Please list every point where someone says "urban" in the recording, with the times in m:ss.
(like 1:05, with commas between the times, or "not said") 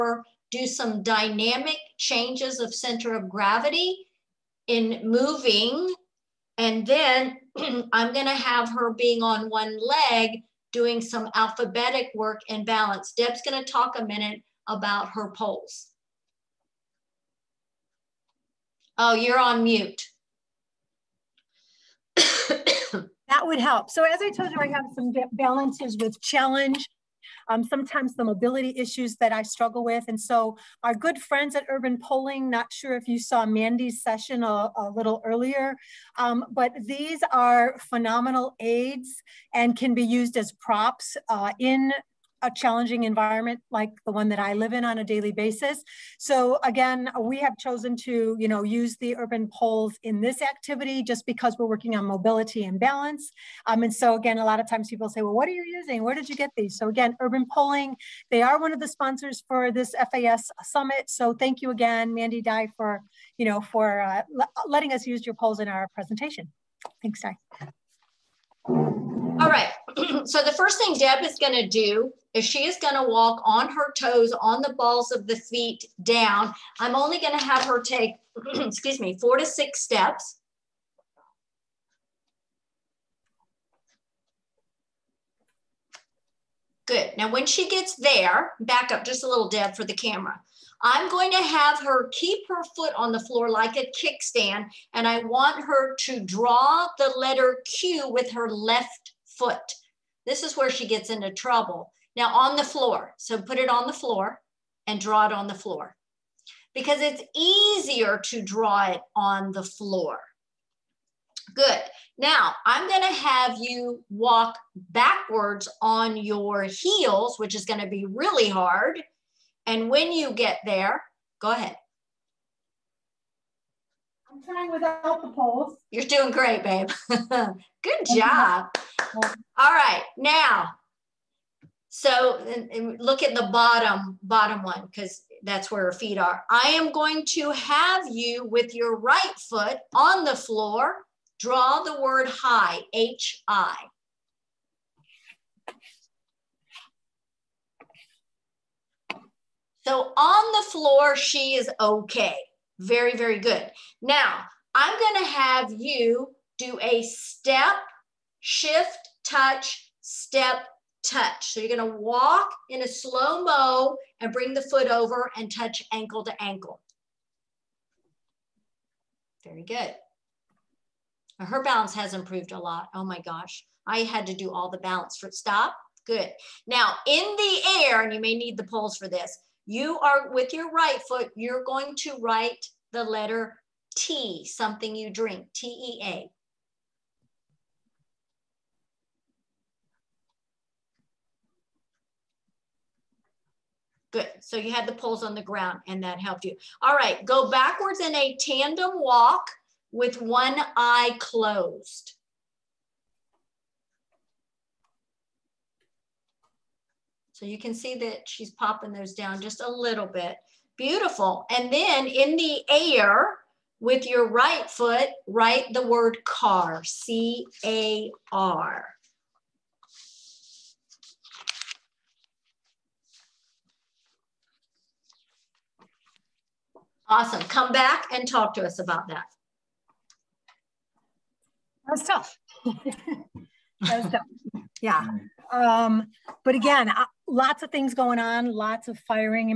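0:31, 0:49, 0:57.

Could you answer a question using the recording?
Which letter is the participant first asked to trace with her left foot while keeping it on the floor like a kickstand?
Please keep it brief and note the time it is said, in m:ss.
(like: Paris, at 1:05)
Q, at 1:37.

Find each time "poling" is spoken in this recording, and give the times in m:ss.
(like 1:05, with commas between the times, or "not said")
0:31, 0:57.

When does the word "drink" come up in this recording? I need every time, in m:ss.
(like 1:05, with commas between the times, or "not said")
3:05.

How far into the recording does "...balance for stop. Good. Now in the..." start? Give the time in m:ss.
2:54.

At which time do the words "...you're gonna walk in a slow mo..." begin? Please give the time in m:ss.
2:41.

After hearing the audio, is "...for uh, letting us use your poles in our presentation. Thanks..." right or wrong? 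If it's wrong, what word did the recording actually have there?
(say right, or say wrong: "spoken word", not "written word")
right.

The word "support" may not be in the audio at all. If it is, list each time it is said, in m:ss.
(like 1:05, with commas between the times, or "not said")
not said.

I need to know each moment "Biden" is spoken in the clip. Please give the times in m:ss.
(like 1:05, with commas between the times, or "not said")
not said.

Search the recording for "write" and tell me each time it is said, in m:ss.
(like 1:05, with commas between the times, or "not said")
3:02, 3:35.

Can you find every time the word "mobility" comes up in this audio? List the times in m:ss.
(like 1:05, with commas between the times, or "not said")
0:28, 0:52.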